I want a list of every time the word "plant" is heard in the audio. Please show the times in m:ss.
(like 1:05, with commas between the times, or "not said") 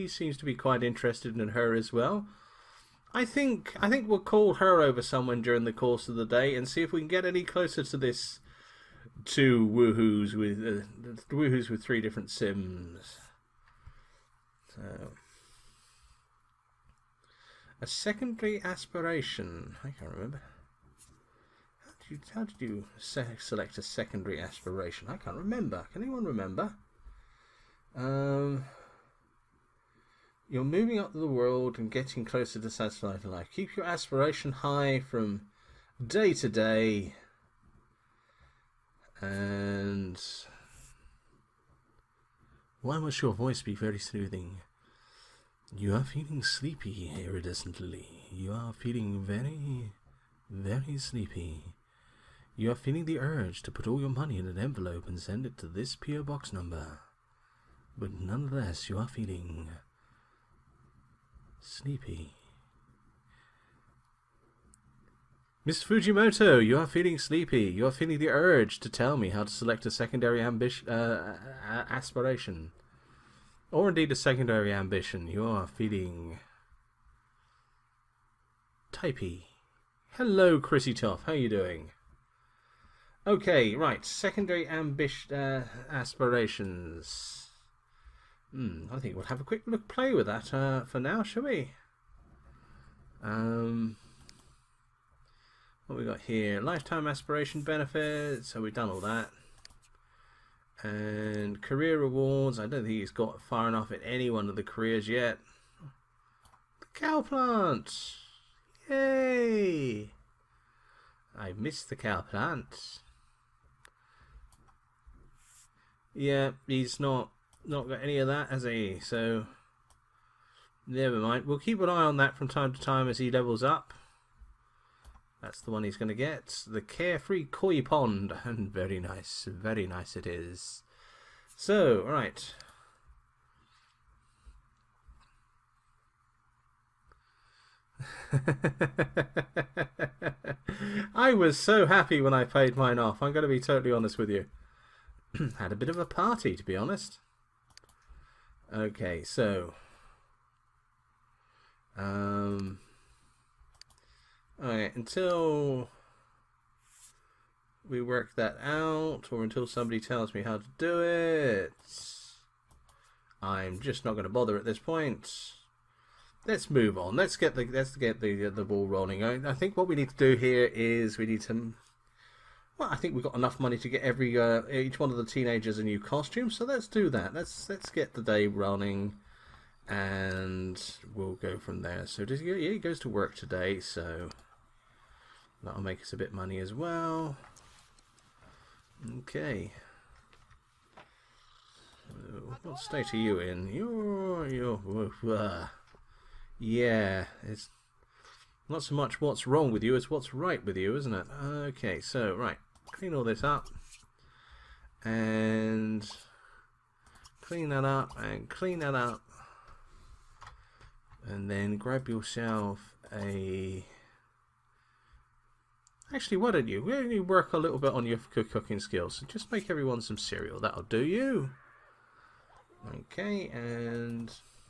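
1:47, 1:52.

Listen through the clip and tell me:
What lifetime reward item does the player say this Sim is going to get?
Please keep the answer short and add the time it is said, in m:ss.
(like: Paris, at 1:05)
Carefree Koi Pond, at 2:06.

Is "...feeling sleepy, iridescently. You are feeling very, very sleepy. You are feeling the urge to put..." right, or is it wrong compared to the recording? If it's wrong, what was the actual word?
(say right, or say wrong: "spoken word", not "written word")
right.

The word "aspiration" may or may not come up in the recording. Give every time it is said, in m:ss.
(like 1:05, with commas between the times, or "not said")
0:18, 0:24, 0:33, 1:11, 1:25, 1:37.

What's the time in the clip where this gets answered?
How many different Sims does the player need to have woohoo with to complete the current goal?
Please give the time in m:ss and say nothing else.
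0:11.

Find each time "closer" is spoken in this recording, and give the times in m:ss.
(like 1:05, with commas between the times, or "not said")
0:07, 0:32.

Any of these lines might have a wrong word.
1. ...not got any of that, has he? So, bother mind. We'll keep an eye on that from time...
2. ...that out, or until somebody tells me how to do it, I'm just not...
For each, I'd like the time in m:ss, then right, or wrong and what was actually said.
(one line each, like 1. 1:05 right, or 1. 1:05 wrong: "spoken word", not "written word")
1. 1:57 wrong: "never", not "bother"
2. 2:38 right.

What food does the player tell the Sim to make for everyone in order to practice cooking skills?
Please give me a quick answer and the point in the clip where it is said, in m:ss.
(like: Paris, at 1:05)
cereal, at 3:40.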